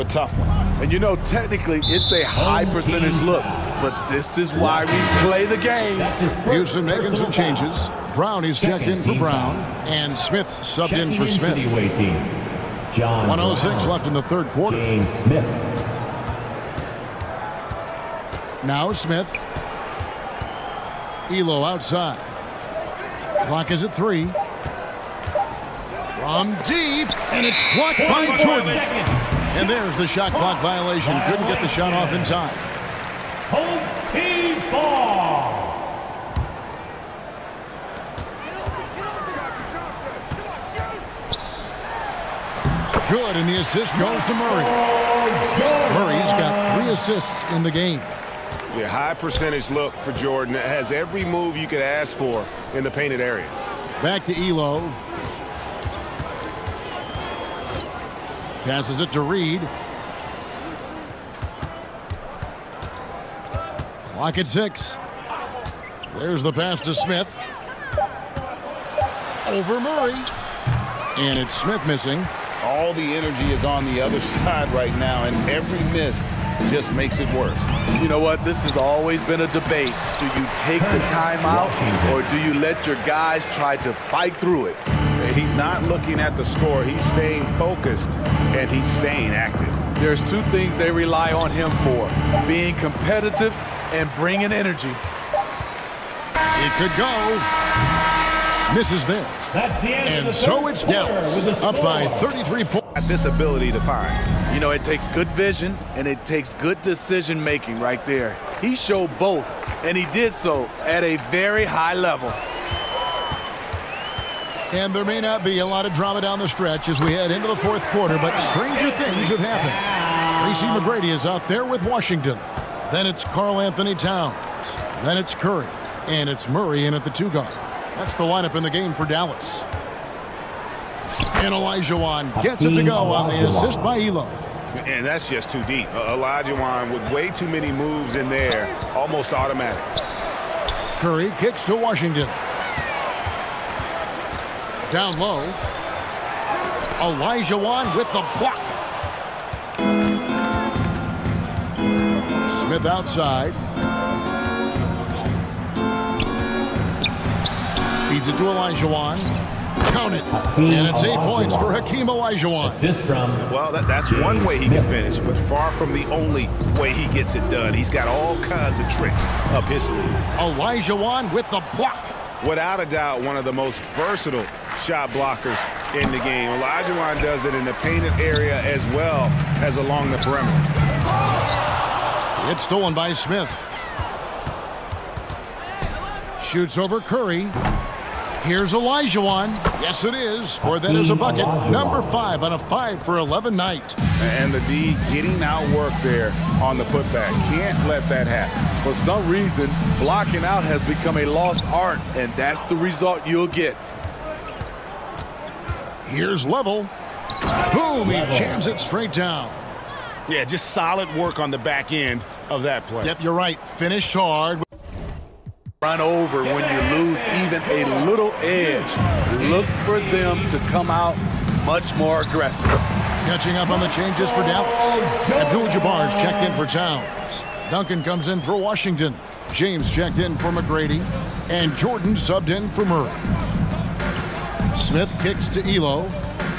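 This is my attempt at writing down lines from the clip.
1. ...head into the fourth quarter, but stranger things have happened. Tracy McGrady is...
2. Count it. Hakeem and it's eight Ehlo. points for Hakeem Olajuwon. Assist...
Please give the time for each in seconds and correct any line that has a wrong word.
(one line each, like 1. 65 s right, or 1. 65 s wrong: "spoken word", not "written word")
1. 117 s right
2. 159 s wrong: "Olajuwon", not "Ehlo".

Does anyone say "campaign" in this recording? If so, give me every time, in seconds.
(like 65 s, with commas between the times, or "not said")
not said.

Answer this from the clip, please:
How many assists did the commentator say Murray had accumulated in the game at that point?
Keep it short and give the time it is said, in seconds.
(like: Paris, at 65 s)
3, at 46 s.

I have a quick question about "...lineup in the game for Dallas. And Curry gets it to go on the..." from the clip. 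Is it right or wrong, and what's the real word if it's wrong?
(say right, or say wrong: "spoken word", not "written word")
wrong: "Olajuwon", not "Curry".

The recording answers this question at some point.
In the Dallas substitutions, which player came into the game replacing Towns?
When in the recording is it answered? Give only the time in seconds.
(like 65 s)
225 s.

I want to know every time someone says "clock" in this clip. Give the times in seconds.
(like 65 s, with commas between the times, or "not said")
23 s, 30 s, 64 s.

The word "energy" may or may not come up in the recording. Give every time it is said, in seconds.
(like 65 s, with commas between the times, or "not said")
73 s, 94 s.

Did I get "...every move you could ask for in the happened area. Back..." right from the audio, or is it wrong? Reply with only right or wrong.
wrong.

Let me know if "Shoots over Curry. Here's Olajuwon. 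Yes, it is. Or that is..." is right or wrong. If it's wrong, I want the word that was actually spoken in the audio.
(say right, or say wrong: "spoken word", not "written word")
right.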